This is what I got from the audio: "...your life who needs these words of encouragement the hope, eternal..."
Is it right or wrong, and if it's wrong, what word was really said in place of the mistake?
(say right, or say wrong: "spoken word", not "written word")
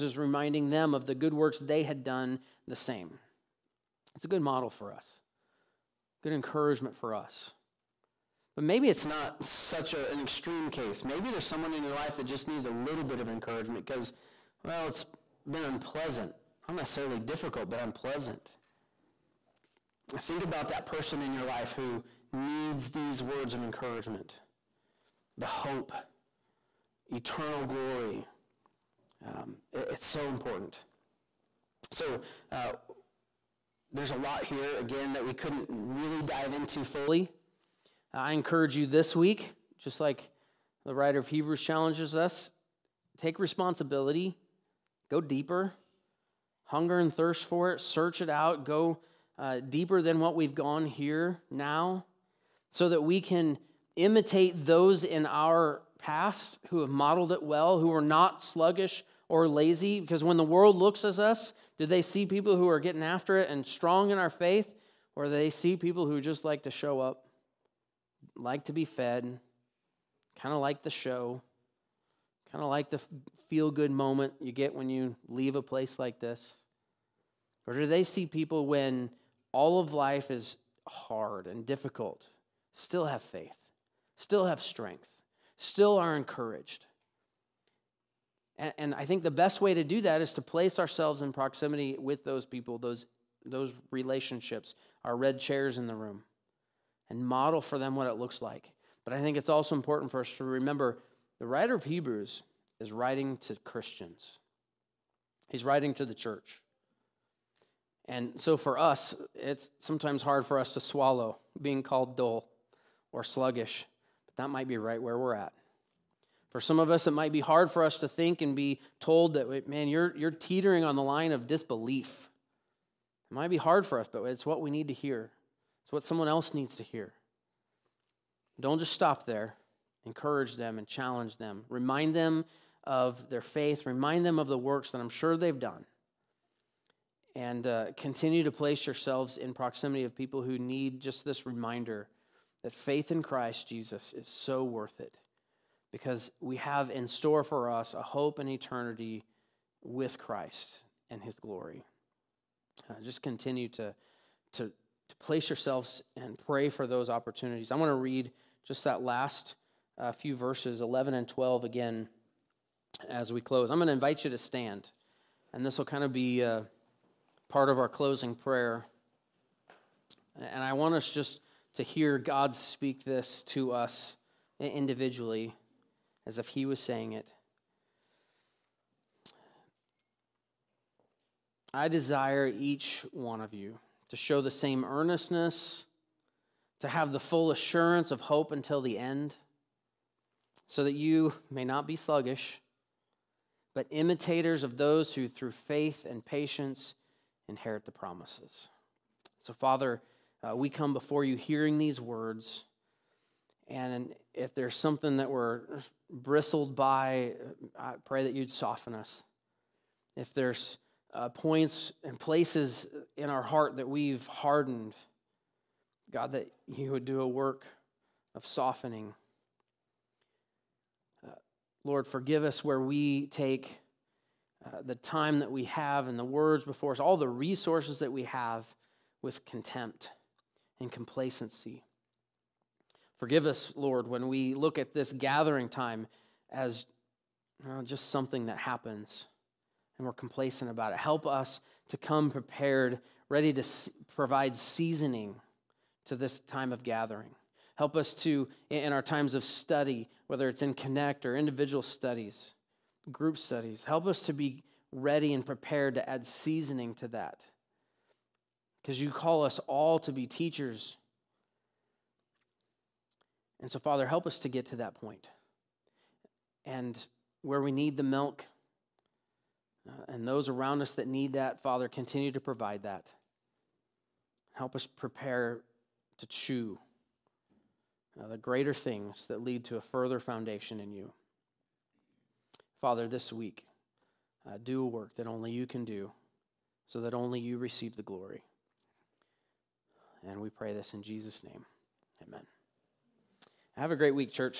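right.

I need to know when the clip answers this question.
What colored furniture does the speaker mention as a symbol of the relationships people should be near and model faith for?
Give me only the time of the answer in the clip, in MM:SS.
01:35.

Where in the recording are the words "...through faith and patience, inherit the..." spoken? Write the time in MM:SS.
03:15.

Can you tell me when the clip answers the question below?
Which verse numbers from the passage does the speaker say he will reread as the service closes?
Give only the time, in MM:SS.
02:40.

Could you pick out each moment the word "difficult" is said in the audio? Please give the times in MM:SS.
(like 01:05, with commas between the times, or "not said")
00:17, 01:21.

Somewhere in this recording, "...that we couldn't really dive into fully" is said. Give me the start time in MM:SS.
00:35.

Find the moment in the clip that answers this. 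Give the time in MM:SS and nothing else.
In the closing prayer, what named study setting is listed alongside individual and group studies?
04:10.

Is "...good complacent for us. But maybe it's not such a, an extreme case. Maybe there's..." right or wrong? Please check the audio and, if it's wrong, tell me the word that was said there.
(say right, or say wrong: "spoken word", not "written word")
wrong: "encouragement", not "complacent".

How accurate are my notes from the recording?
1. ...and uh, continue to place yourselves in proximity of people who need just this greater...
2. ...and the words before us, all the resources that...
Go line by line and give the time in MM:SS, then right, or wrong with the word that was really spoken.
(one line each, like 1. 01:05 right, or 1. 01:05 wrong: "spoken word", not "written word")
1. 02:17 wrong: "reminder", not "greater"
2. 03:46 right.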